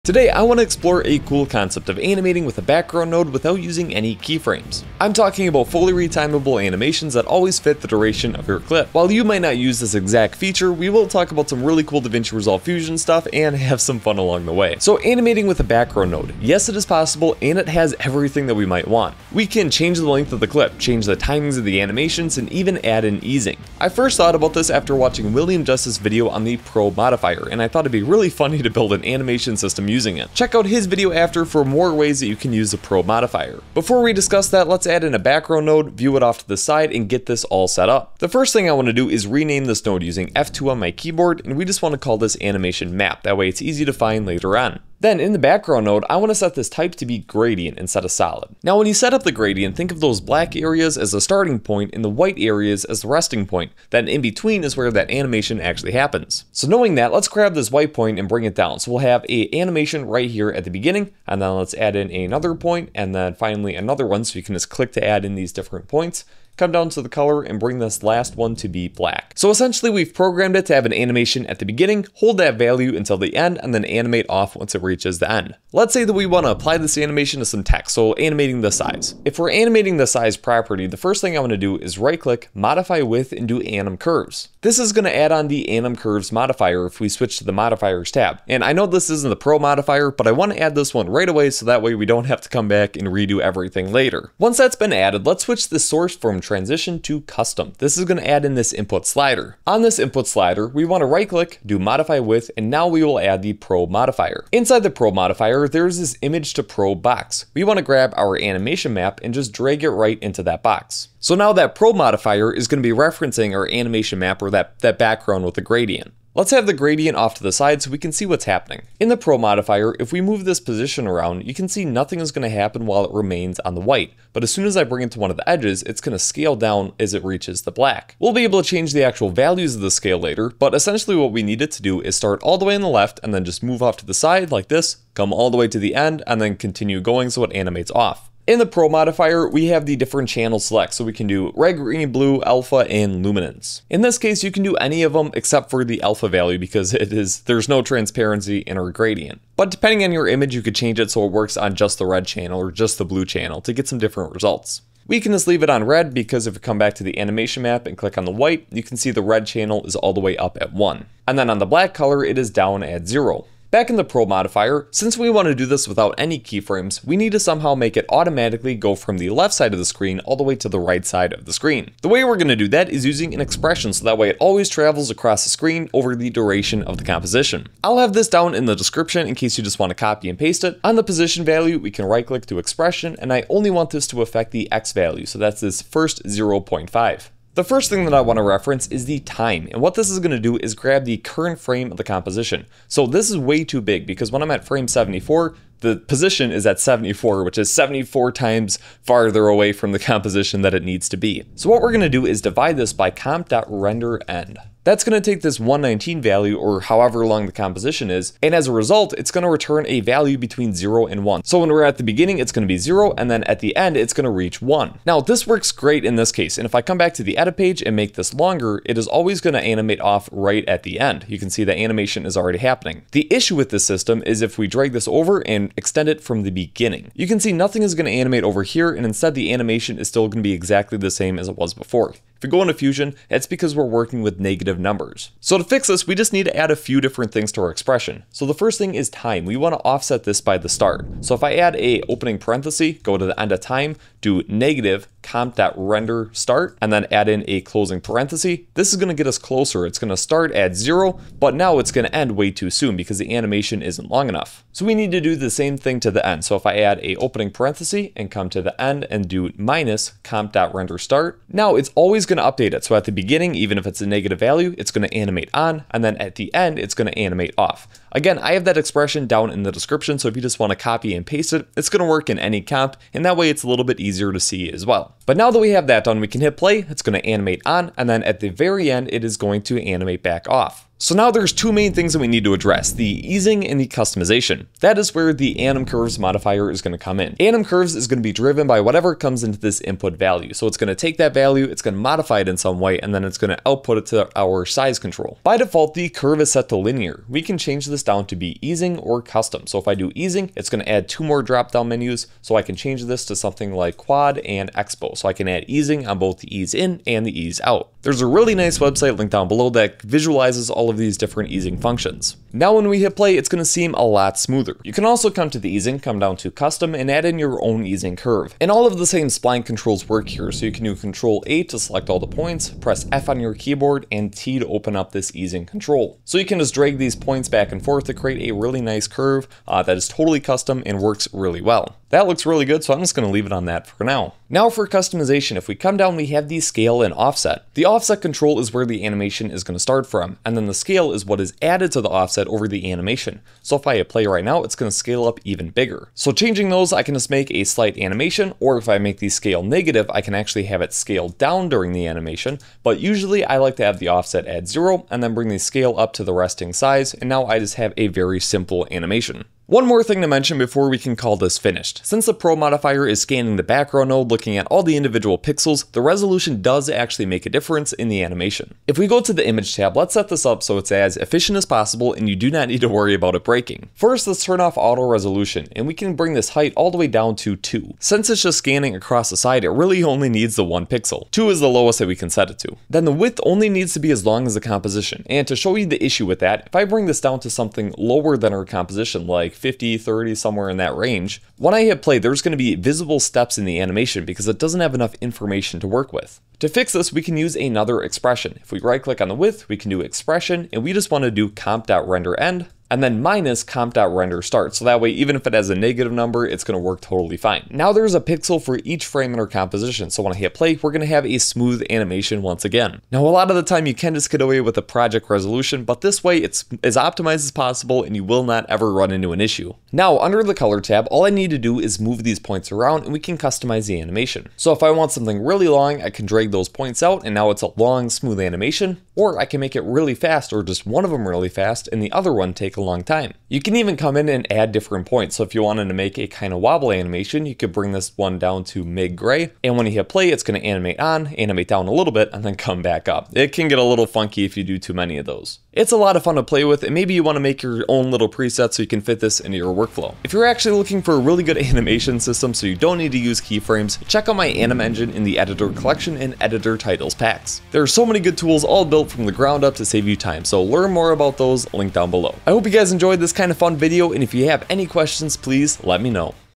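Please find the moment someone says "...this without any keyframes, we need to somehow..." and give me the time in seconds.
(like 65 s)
165 s.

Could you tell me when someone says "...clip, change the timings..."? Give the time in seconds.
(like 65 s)
20 s.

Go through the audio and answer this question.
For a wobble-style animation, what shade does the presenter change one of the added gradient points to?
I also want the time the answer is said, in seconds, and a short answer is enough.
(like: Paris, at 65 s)
mid-gray, at 438 s.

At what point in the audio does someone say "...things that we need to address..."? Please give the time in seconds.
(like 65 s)
281 s.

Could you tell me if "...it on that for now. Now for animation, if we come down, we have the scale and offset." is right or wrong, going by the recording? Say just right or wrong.
wrong.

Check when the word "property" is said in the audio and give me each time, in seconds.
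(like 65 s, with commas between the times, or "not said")
80 s.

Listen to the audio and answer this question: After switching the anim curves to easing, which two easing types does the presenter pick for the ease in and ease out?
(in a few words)
quad and expo.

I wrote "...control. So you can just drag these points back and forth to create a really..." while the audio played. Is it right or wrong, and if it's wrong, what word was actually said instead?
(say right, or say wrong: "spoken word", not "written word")
right.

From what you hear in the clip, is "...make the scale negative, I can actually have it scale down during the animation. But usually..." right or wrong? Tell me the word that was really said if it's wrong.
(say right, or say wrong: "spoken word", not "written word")
right.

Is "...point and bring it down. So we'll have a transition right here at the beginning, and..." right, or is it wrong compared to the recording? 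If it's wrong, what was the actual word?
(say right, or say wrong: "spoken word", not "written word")
wrong: "animation", not "transition".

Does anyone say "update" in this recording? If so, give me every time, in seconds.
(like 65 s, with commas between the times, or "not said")
262 s.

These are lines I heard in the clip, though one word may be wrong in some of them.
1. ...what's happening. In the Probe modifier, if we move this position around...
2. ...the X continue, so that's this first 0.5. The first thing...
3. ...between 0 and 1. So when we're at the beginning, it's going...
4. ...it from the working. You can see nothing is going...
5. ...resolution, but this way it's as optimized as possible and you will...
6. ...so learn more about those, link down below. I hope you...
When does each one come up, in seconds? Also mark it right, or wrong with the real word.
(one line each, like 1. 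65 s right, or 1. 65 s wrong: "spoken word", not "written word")
1. 118 s right
2. 184 s wrong: "value", not "continue"
3. 210 s right
4. 226 s wrong: "beginning", not "working"
5. 415 s right
6. 460 s right.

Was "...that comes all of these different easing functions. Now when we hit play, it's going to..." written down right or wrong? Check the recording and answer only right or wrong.
wrong.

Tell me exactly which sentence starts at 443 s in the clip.
It can get a little funky if you do too many of those.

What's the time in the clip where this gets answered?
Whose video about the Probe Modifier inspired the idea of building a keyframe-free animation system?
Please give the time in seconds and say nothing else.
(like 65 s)
25 s.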